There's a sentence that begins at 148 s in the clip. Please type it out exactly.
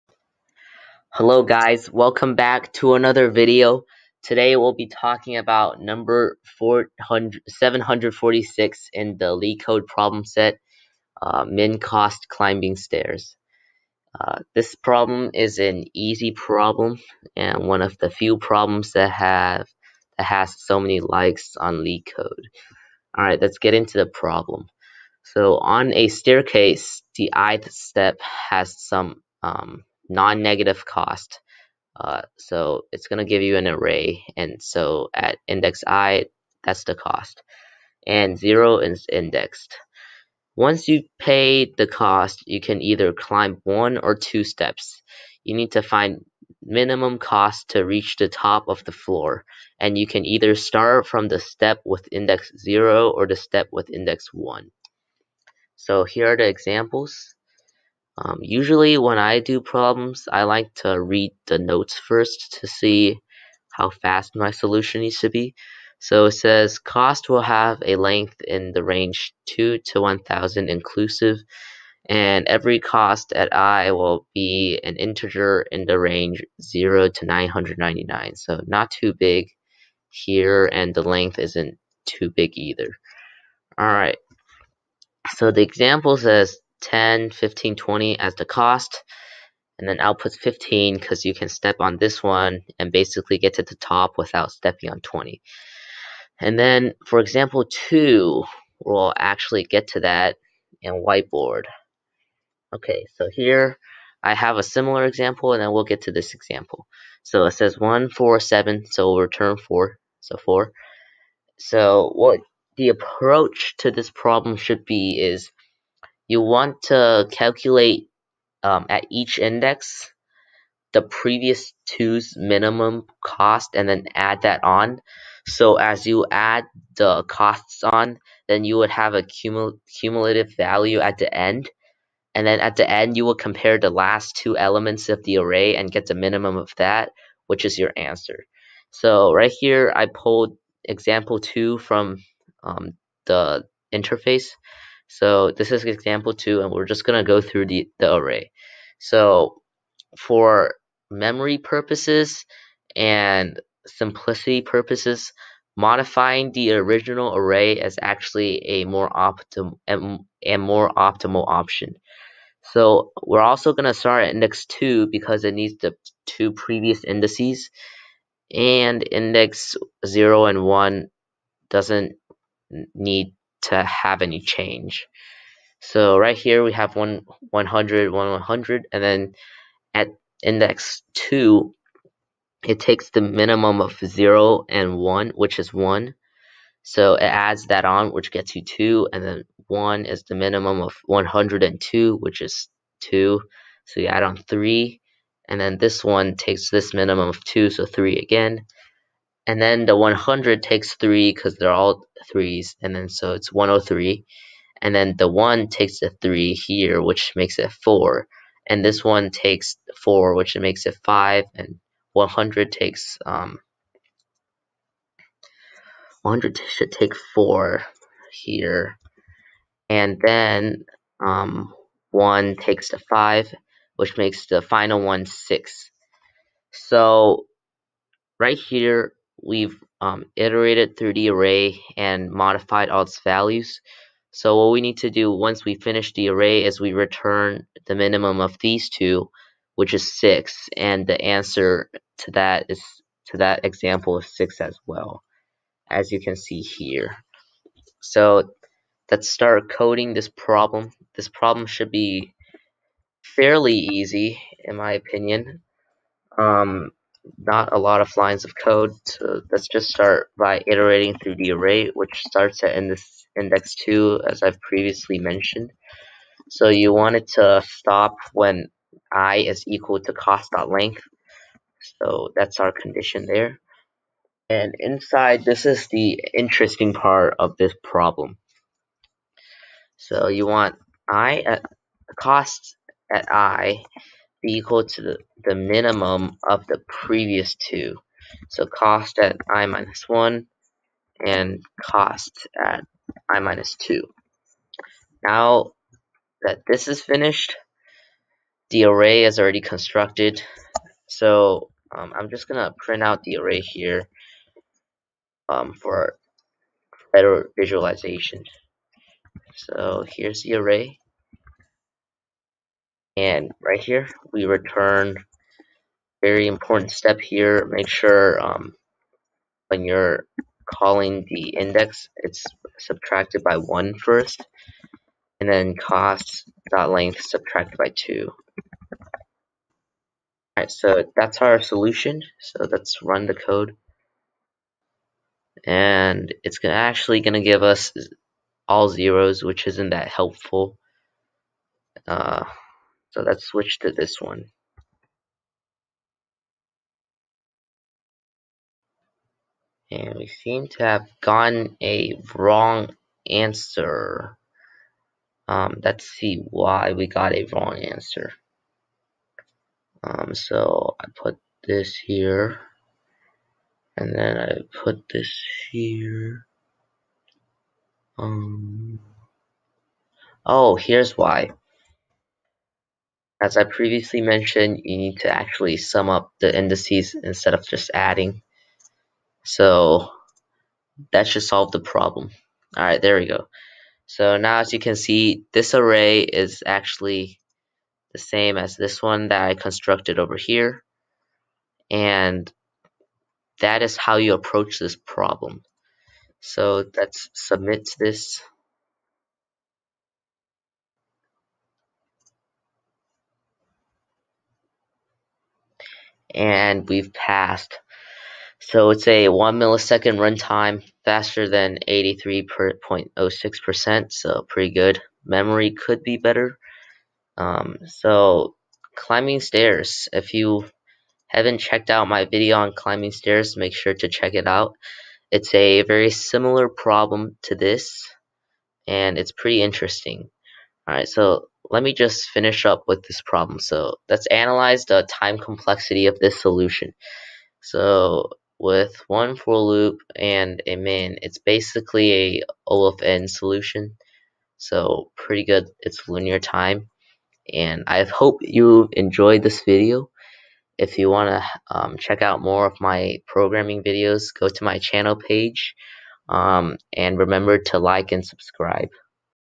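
So for memory purposes and simplicity purposes, modifying the original array is actually a more optimal and, and more optimal option.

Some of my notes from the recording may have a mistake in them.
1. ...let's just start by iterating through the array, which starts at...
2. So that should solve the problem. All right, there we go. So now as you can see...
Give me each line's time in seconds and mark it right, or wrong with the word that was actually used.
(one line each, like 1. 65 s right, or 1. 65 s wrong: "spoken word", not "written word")
1. 259 s right
2. 379 s right.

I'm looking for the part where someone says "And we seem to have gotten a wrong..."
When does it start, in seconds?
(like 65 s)
349 s.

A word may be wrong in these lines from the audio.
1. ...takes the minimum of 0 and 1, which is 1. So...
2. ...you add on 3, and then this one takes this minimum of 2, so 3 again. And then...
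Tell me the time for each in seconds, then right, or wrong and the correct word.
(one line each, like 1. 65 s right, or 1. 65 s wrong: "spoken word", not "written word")
1. 182 s right
2. 193 s right.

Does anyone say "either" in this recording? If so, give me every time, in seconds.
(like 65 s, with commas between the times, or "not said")
42 s, 50 s, 82 s.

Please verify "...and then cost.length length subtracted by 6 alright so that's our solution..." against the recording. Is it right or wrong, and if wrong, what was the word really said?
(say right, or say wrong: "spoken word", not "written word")
wrong: "2", not "6".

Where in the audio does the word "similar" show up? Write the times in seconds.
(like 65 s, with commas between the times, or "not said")
104 s, 426 s.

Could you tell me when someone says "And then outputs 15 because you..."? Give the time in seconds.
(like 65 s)
89 s.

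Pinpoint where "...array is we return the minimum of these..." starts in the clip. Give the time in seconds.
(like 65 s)
236 s.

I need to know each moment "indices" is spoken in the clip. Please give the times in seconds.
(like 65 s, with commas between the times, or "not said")
167 s, 376 s.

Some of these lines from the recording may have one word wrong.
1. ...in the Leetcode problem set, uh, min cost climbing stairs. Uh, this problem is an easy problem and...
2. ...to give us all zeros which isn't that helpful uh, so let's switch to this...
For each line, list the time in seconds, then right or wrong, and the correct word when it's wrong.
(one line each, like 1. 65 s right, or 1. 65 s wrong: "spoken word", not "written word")
1. 8 s right
2. 337 s right.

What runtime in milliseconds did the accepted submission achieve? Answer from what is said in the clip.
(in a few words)
1.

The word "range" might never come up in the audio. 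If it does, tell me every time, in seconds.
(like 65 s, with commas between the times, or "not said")
68 s, 75 s.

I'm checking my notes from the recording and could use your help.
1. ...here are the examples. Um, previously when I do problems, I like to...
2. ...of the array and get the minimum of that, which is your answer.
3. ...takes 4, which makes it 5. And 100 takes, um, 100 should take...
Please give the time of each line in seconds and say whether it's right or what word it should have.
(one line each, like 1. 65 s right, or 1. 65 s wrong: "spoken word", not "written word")
1. 56 s wrong: "usually", not "previously"
2. 135 s right
3. 209 s right.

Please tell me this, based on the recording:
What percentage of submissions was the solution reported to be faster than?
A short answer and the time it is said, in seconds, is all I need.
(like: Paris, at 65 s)
83.06%, at 411 s.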